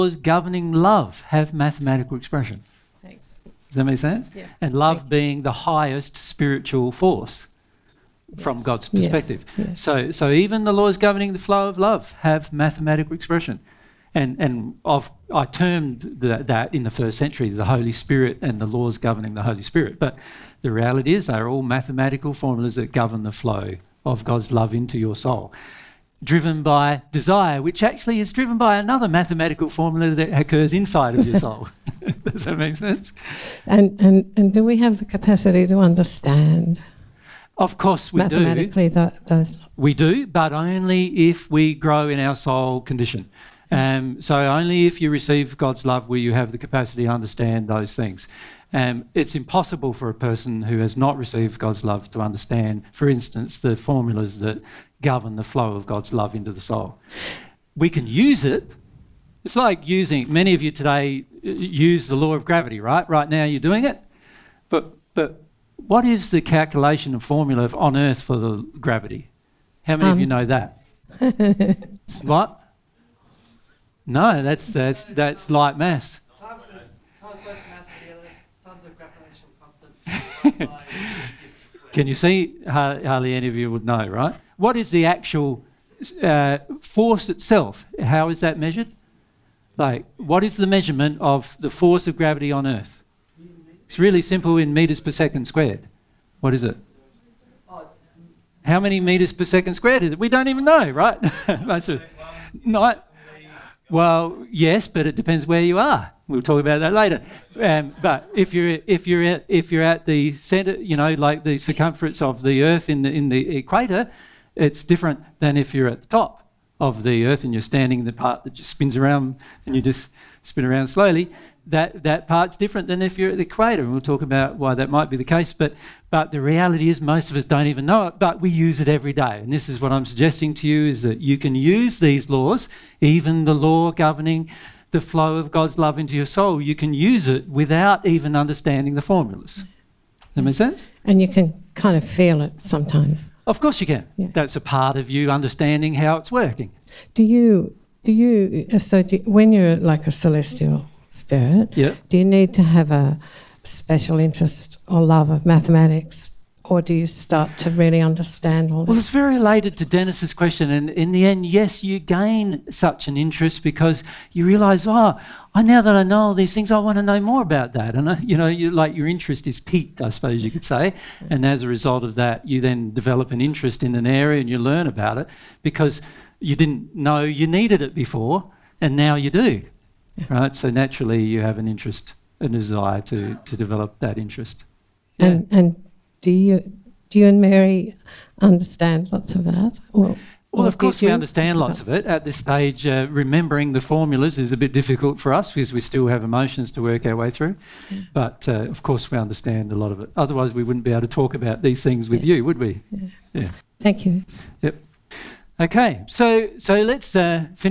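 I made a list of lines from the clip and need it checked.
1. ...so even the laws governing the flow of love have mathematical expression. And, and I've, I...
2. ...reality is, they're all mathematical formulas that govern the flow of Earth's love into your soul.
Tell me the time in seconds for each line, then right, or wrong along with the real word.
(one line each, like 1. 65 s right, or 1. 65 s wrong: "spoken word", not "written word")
1. 10 s right
2. 20 s wrong: "God", not "Earth".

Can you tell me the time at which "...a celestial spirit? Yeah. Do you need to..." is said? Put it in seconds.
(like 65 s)
150 s.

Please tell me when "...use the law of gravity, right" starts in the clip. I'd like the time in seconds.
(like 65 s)
61 s.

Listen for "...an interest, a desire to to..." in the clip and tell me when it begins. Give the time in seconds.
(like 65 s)
181 s.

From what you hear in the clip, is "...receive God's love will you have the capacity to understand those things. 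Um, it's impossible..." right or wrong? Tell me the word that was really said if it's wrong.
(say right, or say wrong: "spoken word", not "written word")
right.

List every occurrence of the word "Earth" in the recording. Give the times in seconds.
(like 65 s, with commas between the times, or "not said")
67 s, 92 s, 112 s, 117 s.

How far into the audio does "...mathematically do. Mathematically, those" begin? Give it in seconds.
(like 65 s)
38 s.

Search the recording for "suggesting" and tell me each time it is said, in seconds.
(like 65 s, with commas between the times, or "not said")
130 s.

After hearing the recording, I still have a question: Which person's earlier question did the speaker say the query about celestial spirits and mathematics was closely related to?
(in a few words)
Dennis.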